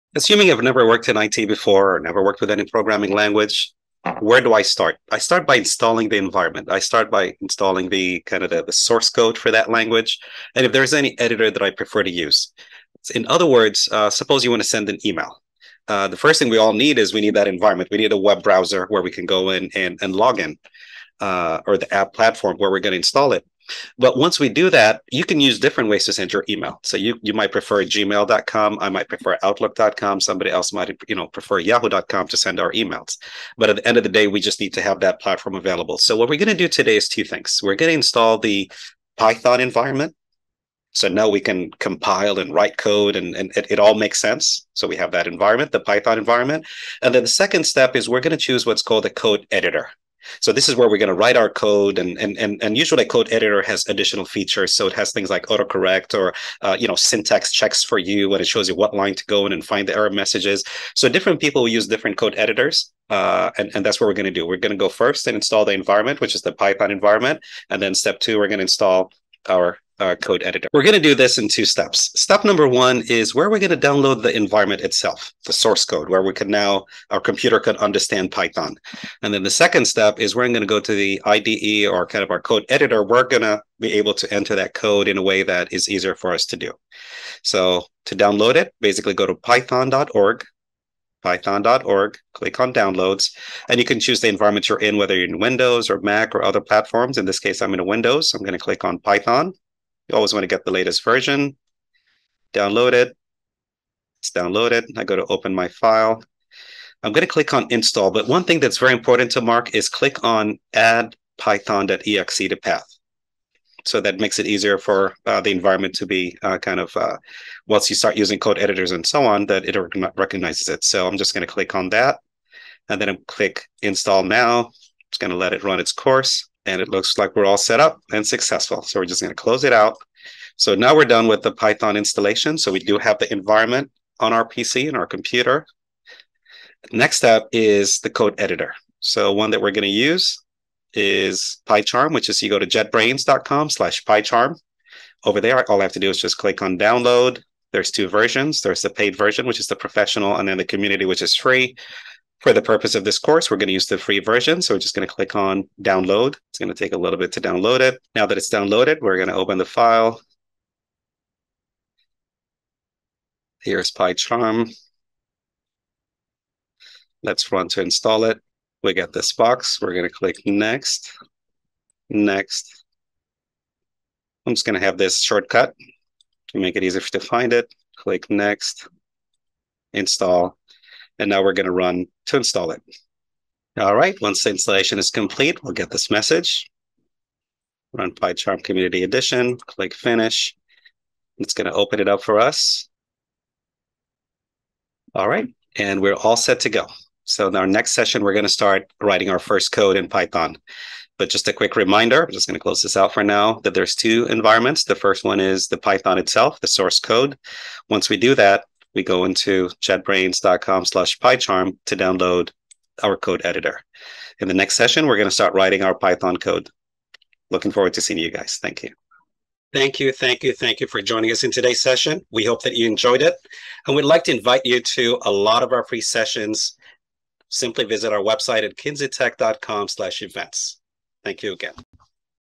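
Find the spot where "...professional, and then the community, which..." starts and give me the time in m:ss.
2:29.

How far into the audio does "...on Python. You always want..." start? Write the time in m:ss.
1:38.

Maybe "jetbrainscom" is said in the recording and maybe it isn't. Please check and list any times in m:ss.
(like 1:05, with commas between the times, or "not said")
2:22, 3:29.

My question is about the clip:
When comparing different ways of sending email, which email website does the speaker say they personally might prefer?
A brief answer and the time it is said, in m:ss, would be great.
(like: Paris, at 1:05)
outlook.com, at 0:29.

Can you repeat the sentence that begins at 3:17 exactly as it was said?
So in our next session, we're going to start writing our first code in Python.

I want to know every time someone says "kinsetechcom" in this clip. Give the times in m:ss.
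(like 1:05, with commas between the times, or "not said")
3:48.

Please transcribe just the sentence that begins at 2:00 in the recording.
So I'm just going to click on that and then i click install now.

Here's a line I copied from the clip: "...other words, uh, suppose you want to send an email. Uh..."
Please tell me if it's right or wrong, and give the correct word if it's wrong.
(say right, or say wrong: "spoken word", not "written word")
right.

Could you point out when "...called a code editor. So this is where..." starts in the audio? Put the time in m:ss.
0:48.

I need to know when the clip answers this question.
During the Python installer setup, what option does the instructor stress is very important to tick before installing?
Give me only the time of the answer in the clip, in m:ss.
1:50.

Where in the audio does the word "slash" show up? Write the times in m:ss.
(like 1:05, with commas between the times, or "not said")
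2:23, 3:30, 3:49.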